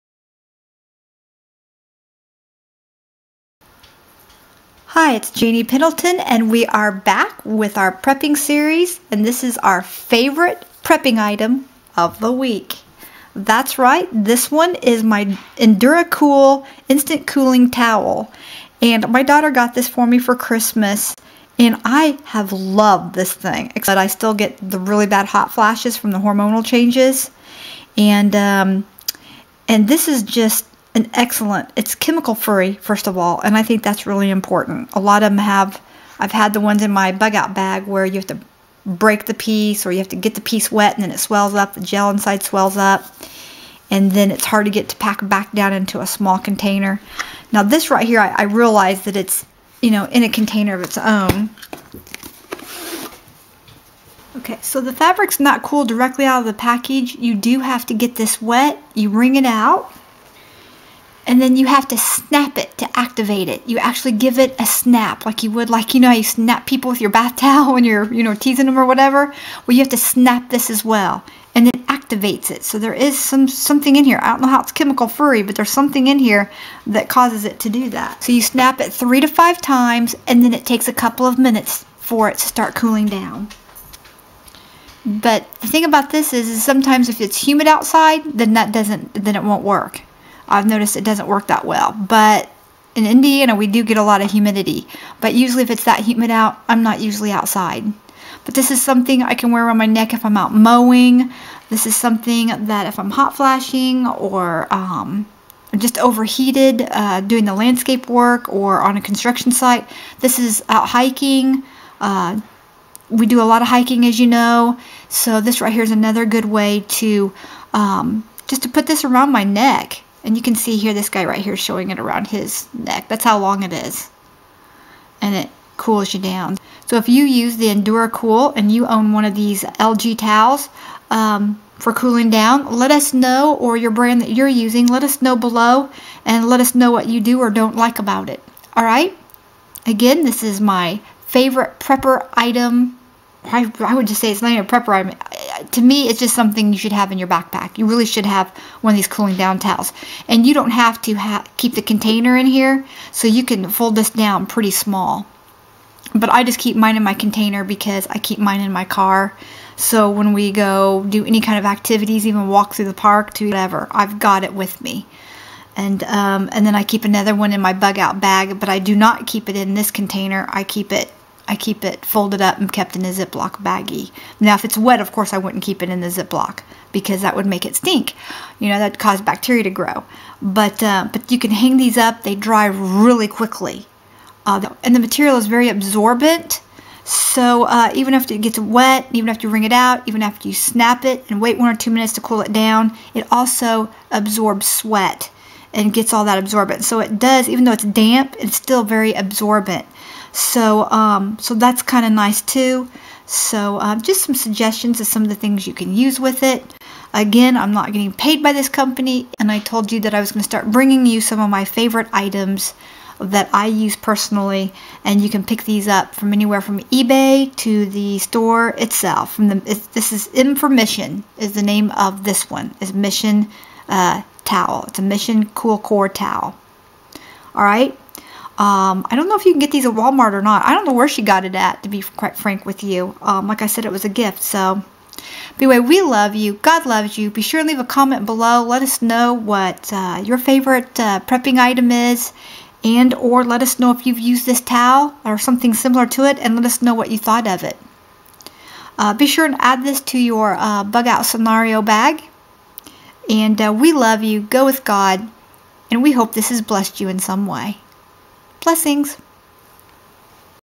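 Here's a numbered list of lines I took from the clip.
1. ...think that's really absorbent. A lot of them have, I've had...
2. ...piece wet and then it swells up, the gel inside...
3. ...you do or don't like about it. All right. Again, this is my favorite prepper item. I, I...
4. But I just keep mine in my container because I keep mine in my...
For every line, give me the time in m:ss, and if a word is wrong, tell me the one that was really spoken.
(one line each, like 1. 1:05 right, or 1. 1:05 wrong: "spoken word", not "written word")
1. 0:33 wrong: "important", not "absorbent"
2. 0:40 right
3. 2:17 right
4. 2:36 right.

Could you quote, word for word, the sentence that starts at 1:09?
Well, you have to snap this as well, and it activates it.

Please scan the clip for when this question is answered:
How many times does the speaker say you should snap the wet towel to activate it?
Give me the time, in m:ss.
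1:18.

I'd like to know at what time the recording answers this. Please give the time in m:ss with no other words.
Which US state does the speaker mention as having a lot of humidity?
1:33.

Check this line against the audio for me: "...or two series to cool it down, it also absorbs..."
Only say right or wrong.
wrong.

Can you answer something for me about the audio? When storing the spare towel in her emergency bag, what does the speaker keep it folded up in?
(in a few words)
A Ziploc baggie.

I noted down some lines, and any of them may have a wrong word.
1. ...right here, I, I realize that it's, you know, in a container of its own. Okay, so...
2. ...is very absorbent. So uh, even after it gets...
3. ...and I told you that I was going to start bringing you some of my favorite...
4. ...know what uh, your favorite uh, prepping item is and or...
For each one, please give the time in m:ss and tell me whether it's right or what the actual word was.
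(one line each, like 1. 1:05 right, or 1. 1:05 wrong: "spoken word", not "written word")
1. 0:47 right
2. 3:05 right
3. 3:29 right
4. 3:59 right.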